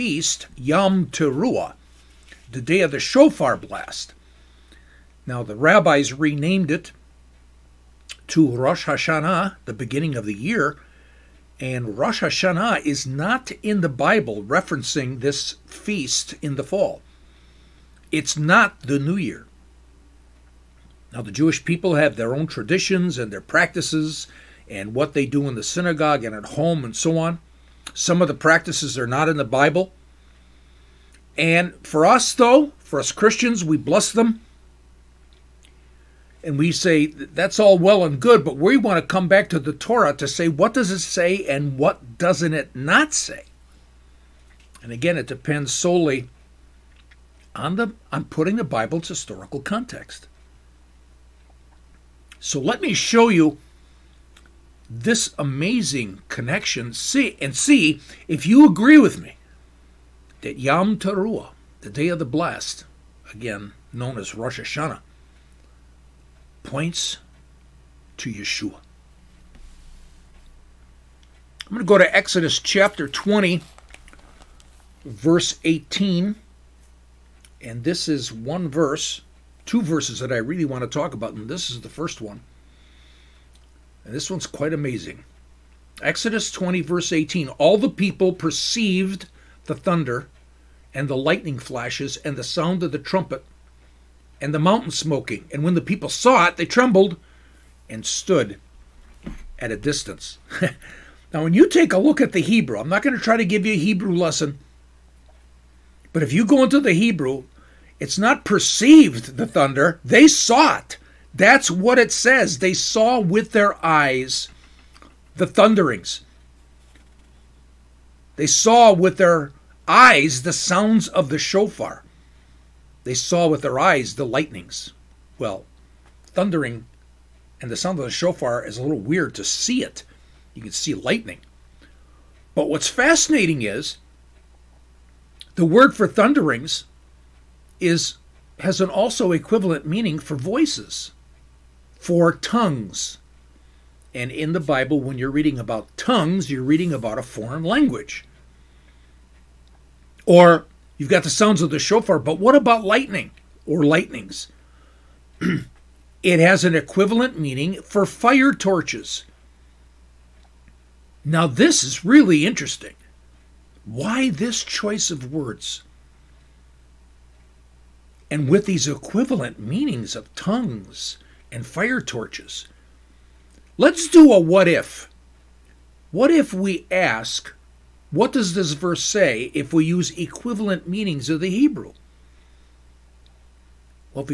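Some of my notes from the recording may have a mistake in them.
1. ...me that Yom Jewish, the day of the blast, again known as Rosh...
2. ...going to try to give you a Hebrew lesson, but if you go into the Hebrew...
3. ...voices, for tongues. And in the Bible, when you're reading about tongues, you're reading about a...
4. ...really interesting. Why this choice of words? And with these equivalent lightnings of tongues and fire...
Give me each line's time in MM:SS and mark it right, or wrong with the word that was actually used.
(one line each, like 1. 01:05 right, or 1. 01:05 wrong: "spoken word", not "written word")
1. 00:59 wrong: "Teruah", not "Jewish"
2. 01:43 right
3. 02:20 right
4. 02:42 wrong: "meanings", not "lightnings".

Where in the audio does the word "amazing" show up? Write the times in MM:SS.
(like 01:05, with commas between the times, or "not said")
00:55, 01:24.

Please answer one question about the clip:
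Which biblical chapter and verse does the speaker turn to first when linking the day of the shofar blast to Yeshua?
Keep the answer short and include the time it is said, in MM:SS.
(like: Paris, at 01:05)
Exodus 20:18, at 01:12.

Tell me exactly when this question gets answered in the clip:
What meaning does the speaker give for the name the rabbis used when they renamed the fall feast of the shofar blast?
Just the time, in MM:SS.
00:09.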